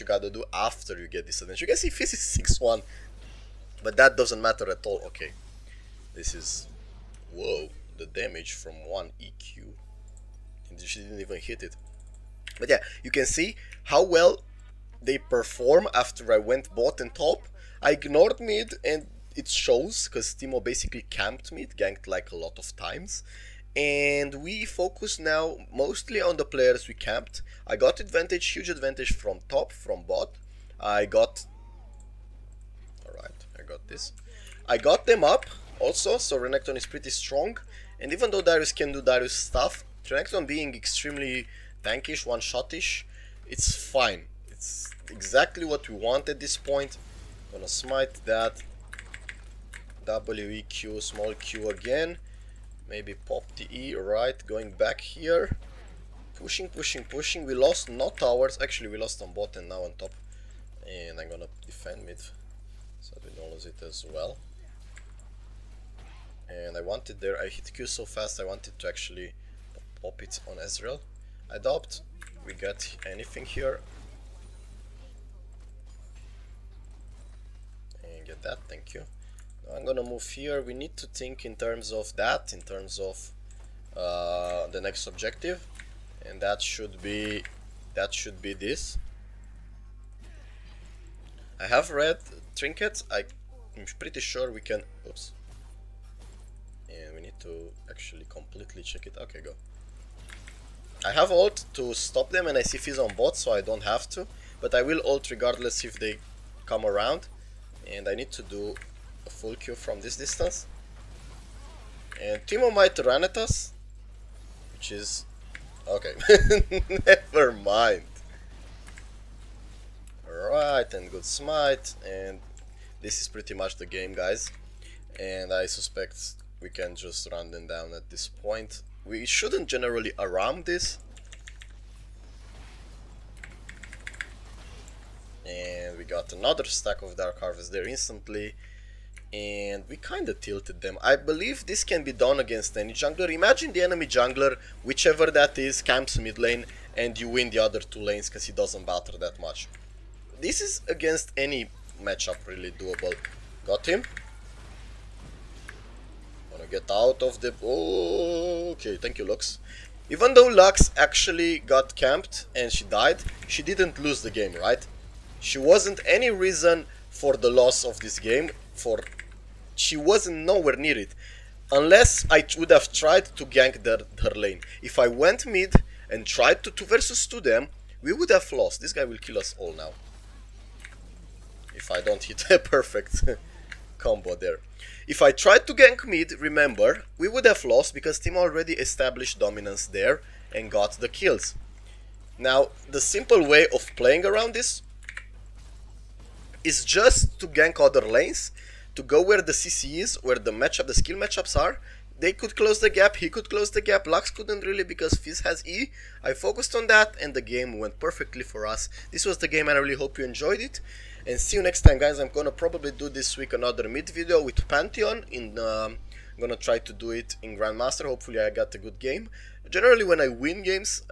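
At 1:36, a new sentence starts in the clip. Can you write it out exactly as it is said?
And we need to actually completely check it.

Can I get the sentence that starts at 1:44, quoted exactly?
But I will ult regardless if they come around.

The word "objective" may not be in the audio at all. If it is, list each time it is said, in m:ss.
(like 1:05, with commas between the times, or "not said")
1:25.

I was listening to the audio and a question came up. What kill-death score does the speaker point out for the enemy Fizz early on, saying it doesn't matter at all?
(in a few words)
6-1.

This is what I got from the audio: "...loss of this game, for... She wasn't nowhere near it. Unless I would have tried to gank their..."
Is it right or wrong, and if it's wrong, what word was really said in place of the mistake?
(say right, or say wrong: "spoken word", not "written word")
right.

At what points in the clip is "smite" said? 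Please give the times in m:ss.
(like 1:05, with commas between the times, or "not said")
0:47, 2:01.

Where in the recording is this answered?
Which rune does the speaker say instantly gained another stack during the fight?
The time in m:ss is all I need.
2:17.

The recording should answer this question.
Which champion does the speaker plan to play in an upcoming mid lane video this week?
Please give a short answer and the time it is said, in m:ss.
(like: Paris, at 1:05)
Pantheon, at 3:34.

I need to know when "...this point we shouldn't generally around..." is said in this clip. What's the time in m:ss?
2:08.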